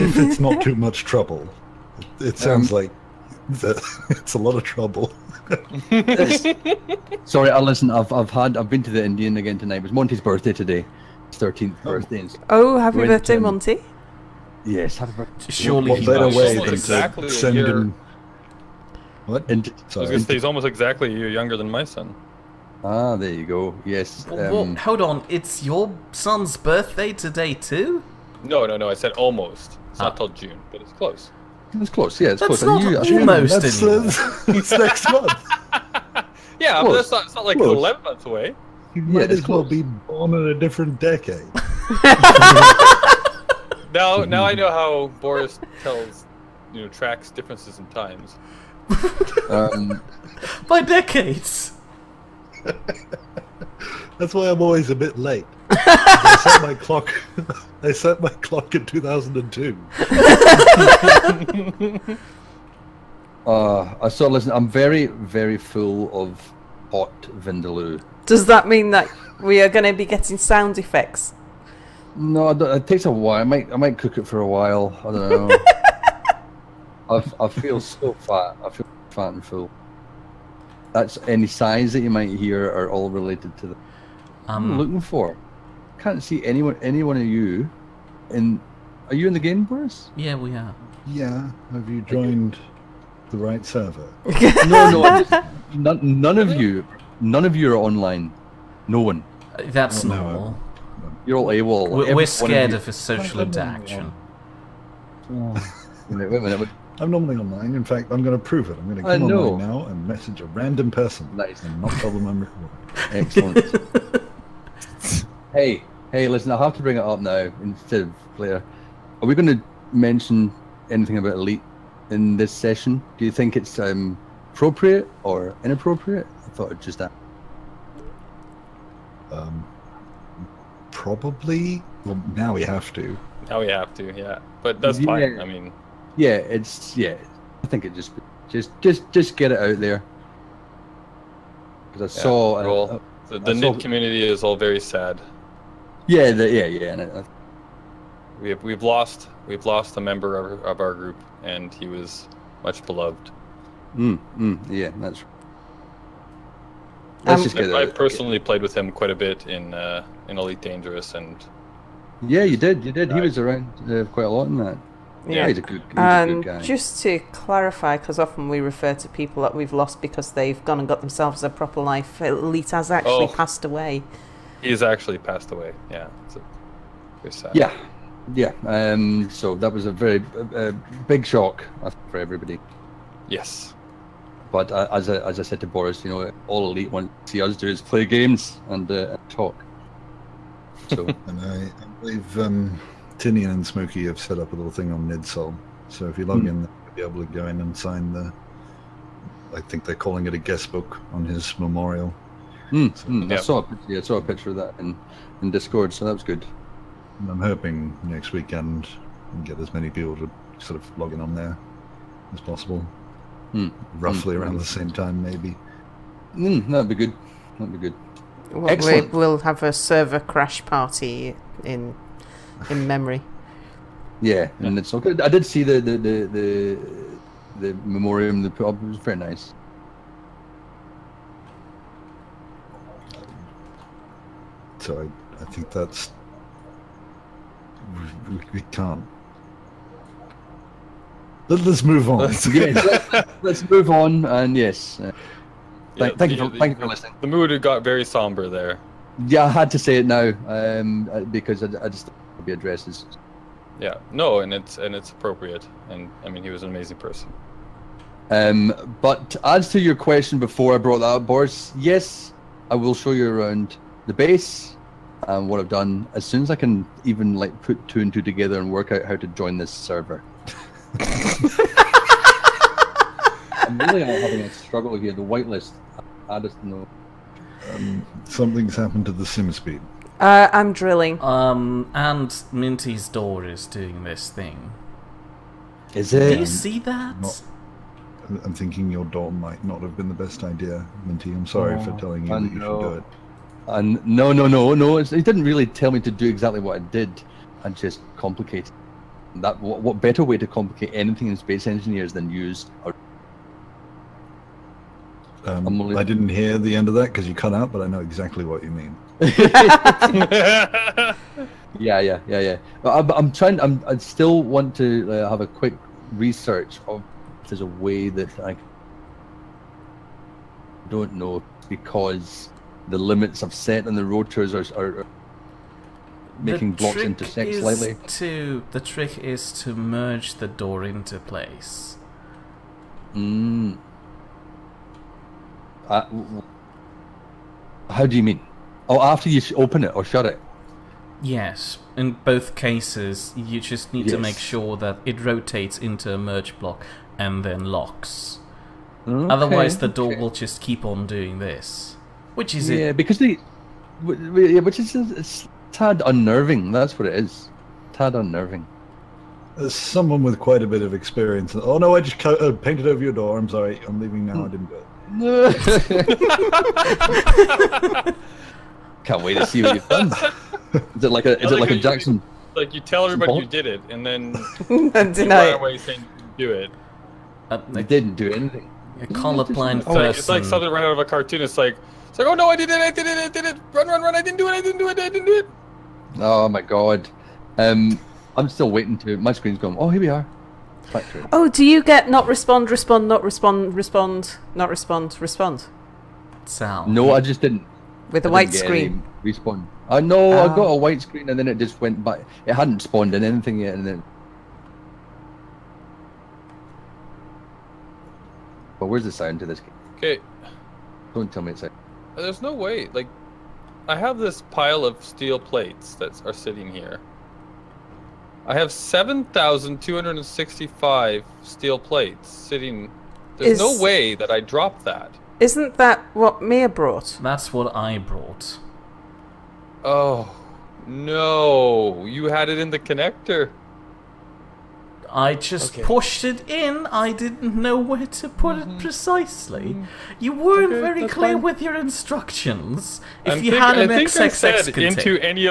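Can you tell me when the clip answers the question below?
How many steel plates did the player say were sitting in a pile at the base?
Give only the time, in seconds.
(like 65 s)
418 s.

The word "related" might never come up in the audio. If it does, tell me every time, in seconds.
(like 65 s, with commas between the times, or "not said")
83 s.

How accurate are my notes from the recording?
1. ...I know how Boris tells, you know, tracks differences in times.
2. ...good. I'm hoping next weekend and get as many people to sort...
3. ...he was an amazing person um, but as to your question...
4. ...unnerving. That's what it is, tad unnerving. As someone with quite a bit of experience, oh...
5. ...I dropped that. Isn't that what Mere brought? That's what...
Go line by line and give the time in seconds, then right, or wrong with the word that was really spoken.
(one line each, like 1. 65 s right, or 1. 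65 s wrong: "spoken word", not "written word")
1. 44 s right
2. 206 s right
3. 256 s right
4. 356 s right
5. 424 s right.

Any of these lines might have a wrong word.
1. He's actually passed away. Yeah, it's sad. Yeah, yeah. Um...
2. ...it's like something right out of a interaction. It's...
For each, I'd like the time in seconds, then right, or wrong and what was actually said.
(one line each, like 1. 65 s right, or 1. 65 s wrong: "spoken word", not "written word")
1. 174 s right
2. 380 s wrong: "cartoon", not "interaction".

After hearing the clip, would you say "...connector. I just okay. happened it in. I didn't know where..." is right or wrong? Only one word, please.
wrong.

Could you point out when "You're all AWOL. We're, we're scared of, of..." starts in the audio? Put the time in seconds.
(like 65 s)
101 s.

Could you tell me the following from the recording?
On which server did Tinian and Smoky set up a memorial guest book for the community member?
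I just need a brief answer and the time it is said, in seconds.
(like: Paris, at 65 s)
NidSol, at 195 s.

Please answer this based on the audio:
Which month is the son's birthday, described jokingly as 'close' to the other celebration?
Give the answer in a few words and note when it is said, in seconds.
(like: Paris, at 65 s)
June, at 30 s.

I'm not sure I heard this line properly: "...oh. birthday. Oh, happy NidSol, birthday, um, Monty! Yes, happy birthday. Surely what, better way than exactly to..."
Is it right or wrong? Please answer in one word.
wrong.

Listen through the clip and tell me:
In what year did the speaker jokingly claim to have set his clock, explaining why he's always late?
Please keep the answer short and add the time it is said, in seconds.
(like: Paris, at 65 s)
2002, at 58 s.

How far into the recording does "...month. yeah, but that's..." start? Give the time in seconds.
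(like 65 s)
35 s.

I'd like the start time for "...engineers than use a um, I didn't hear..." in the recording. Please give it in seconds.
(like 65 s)
301 s.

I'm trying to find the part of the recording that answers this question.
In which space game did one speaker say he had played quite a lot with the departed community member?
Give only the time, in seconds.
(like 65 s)
160 s.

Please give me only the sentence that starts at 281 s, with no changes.
Um, and Minty's door is doing this thing.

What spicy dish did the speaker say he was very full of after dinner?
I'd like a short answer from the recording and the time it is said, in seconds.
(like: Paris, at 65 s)
Vindaloo, at 66 s.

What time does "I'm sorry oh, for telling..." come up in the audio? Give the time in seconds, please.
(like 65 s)
291 s.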